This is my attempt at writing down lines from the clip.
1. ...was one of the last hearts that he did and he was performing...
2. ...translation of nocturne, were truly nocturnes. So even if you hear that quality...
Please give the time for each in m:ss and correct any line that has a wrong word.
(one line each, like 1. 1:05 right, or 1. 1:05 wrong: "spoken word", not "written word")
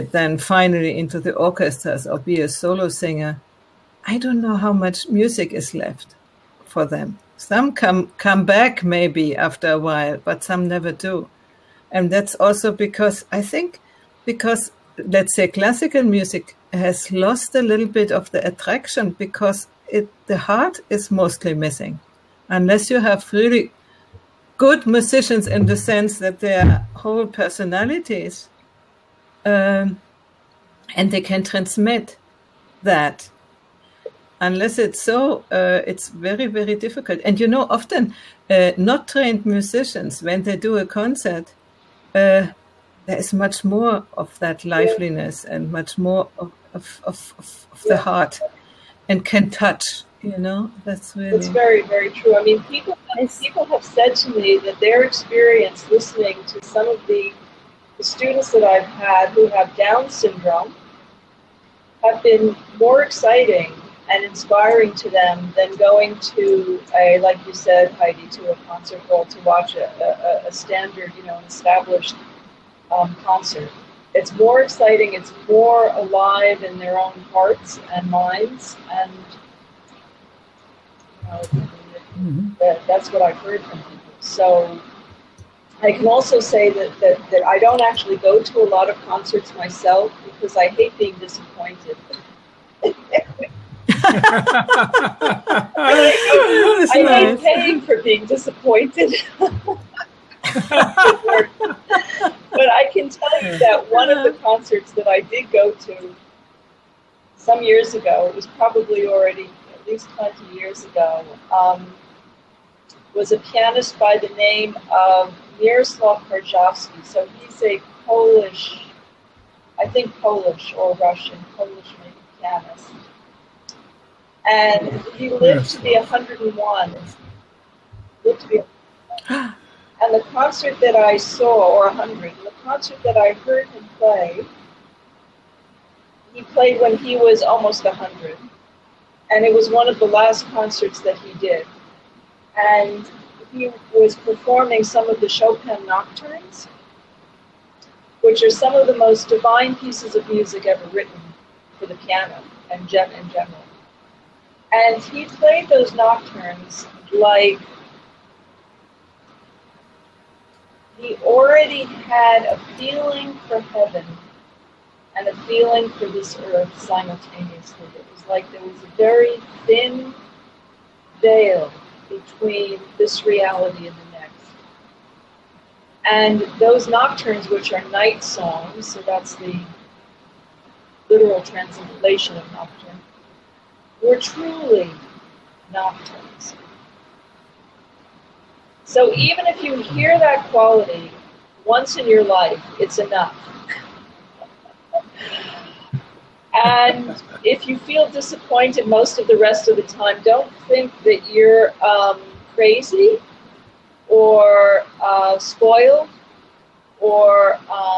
1. 2:19 wrong: "concerts", not "hearts"
2. 3:01 right.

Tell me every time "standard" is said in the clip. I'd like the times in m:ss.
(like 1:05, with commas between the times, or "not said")
1:10.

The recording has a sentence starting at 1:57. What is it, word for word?
So he's a Polish, I think Polish or Russian, Polish maybe pianist.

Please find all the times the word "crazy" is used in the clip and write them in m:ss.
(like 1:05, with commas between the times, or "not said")
3:22.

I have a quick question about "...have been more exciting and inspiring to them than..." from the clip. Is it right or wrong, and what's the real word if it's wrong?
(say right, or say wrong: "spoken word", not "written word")
right.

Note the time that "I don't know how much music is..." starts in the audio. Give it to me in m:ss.
0:04.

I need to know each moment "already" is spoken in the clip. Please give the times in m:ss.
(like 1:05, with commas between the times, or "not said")
1:49, 2:41.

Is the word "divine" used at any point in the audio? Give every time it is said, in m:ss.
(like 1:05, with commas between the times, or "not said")
2:29.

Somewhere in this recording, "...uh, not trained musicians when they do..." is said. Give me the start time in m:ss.
0:38.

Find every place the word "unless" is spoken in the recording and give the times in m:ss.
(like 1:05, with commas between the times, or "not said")
0:22, 0:34.